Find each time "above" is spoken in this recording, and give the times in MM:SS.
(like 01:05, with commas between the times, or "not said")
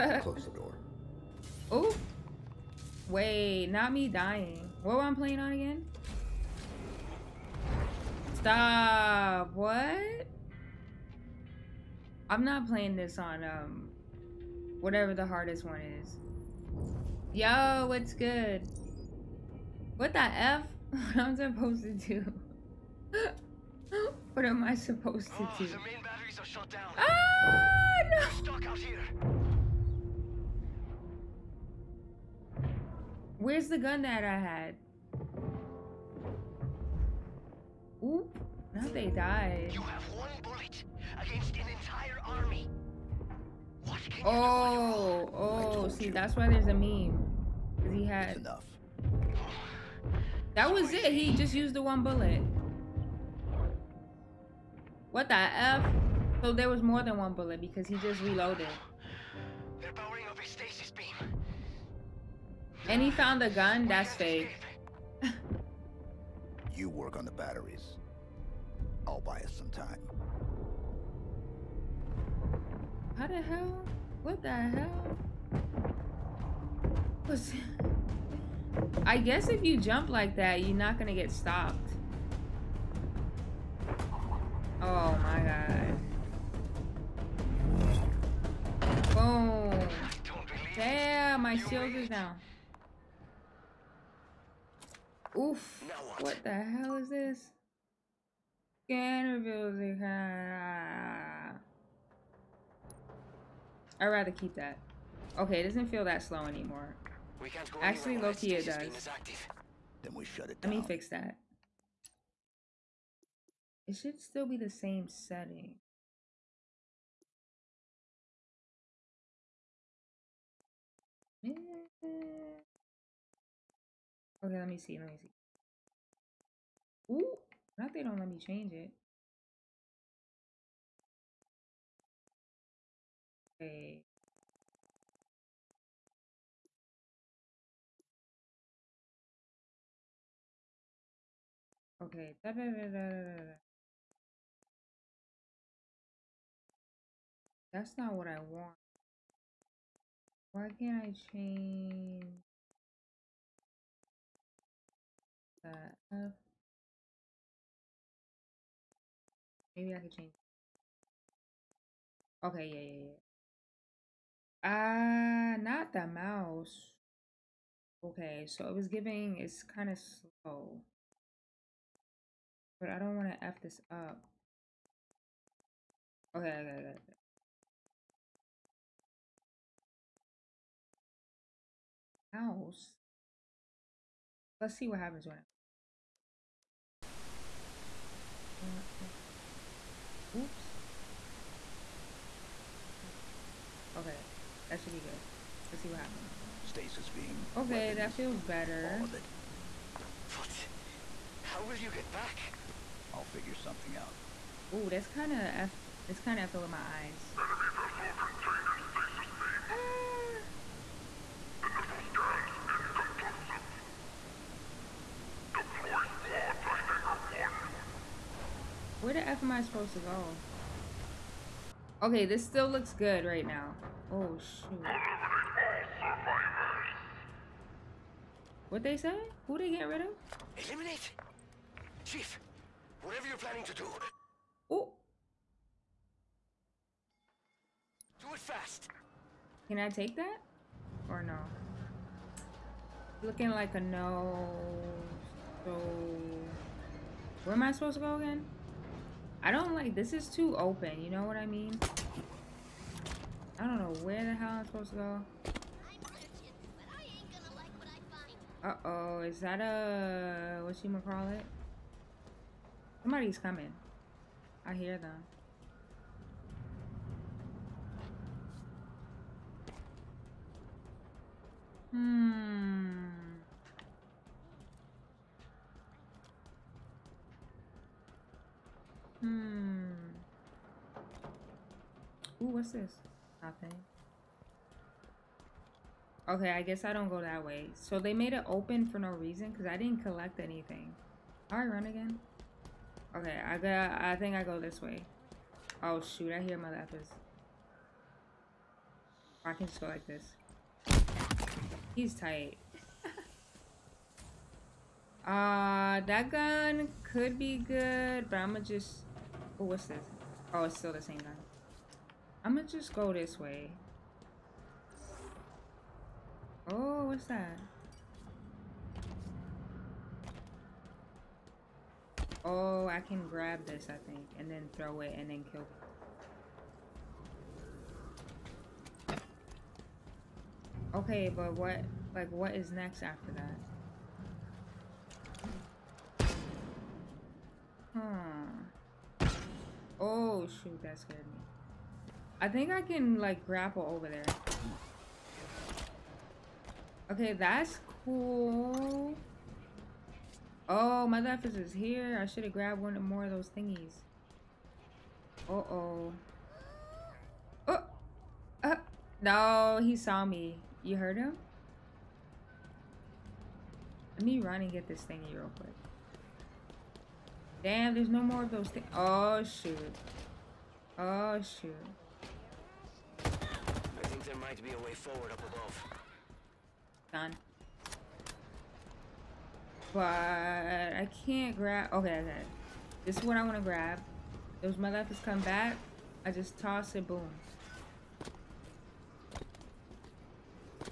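06:15.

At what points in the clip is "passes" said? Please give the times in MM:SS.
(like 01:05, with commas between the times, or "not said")
not said.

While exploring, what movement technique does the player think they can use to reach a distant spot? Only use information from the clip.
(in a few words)
grapple.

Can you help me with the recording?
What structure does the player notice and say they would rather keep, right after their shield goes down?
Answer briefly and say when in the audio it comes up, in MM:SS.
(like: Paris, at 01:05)
Scanner building, at 01:38.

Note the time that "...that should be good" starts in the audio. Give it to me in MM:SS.
03:14.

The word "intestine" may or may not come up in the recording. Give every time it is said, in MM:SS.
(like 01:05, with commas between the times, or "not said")
not said.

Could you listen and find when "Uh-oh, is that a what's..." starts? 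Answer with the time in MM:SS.
04:18.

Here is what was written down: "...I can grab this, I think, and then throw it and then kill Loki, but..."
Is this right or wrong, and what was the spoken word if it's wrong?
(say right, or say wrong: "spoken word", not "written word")
wrong: "Okay", not "Loki".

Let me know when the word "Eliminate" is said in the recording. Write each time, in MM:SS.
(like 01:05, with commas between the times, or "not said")
03:50.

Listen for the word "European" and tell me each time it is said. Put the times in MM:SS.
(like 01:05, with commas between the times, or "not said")
not said.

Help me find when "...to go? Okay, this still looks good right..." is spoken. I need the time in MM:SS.
03:39.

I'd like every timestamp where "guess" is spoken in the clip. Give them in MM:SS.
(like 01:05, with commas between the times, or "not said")
01:19, 04:46.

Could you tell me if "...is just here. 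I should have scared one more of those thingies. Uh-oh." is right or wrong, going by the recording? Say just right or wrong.
wrong.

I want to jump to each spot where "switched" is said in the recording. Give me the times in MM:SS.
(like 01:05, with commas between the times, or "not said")
not said.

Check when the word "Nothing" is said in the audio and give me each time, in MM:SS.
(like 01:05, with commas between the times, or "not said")
04:43.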